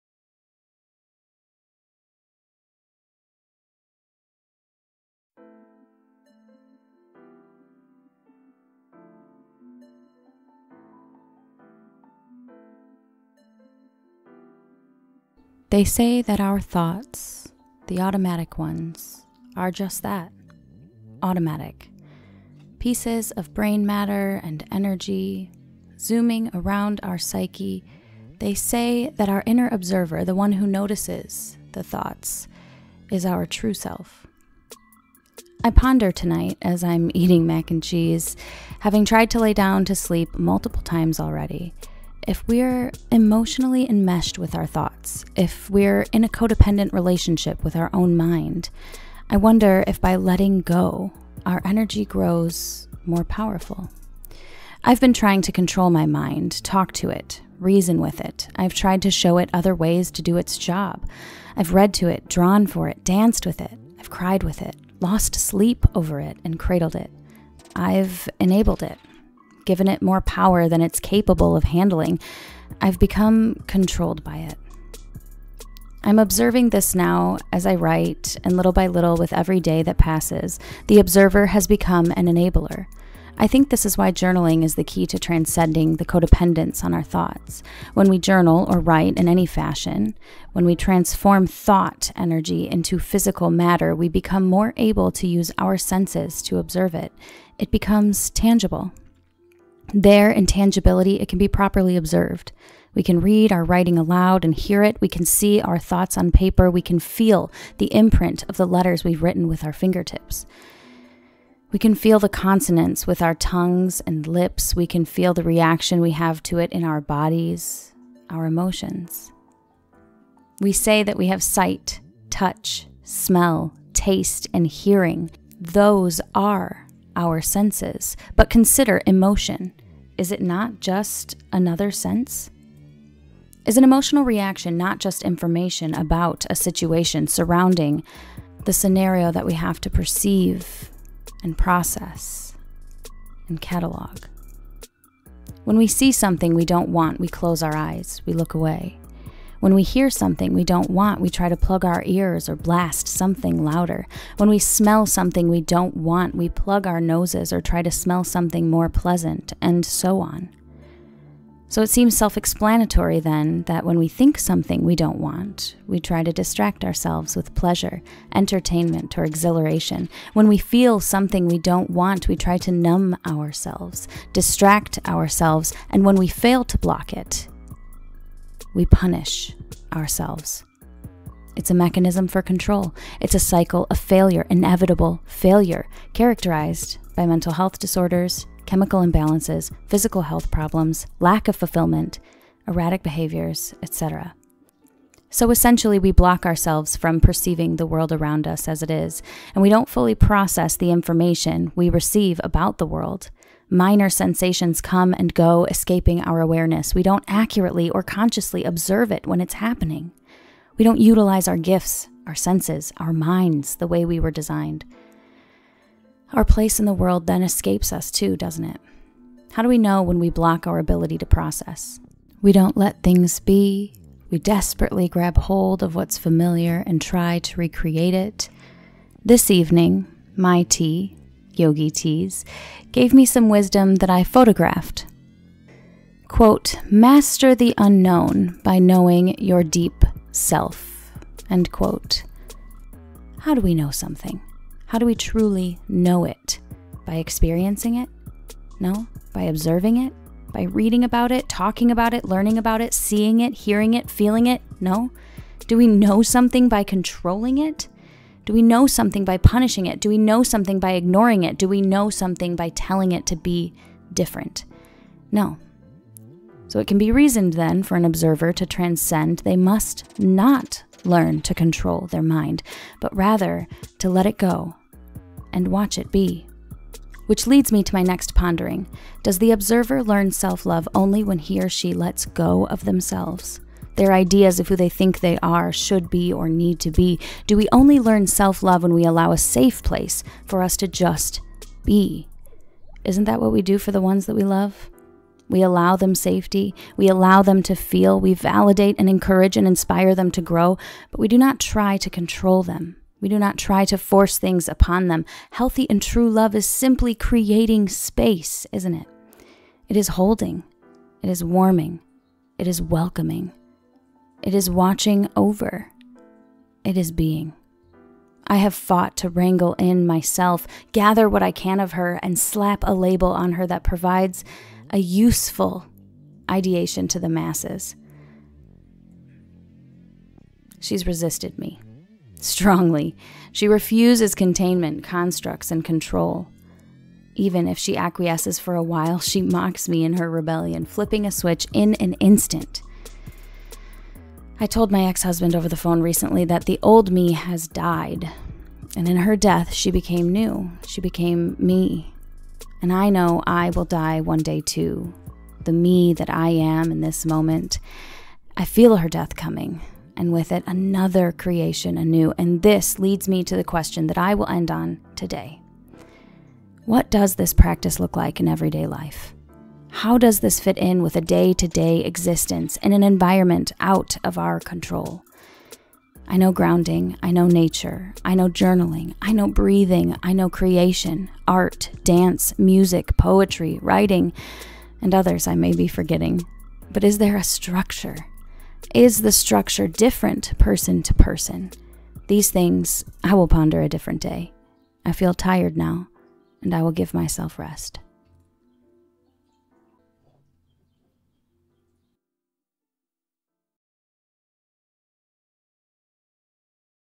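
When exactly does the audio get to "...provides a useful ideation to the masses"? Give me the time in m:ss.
5:23.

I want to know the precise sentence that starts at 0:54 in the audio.
I've been trying to control my mind, talk to it, reason with it.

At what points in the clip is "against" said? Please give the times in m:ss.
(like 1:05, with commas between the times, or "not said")
not said.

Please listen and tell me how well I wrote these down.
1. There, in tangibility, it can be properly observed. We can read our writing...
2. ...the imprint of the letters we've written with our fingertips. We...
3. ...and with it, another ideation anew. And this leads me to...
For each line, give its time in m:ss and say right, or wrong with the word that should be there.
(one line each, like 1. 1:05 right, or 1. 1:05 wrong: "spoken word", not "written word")
1. 1:39 right
2. 1:47 right
3. 6:00 wrong: "creation", not "ideation".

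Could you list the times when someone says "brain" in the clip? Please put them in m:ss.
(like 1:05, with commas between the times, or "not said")
0:23.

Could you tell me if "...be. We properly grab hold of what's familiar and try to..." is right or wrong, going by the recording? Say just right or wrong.
wrong.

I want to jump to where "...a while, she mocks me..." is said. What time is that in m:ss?
5:38.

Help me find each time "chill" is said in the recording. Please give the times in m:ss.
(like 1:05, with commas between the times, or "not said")
not said.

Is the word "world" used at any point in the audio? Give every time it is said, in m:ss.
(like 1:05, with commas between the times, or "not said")
3:17, 3:22, 3:36.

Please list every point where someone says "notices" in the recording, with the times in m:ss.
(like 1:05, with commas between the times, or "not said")
0:30.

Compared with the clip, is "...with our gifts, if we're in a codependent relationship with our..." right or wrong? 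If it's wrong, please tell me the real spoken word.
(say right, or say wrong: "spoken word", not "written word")
wrong: "thoughts", not "gifts".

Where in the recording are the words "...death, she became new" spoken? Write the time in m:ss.
5:49.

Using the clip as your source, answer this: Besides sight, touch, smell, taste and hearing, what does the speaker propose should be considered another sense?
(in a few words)
emotion.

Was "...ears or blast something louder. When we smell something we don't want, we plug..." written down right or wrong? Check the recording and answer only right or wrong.
right.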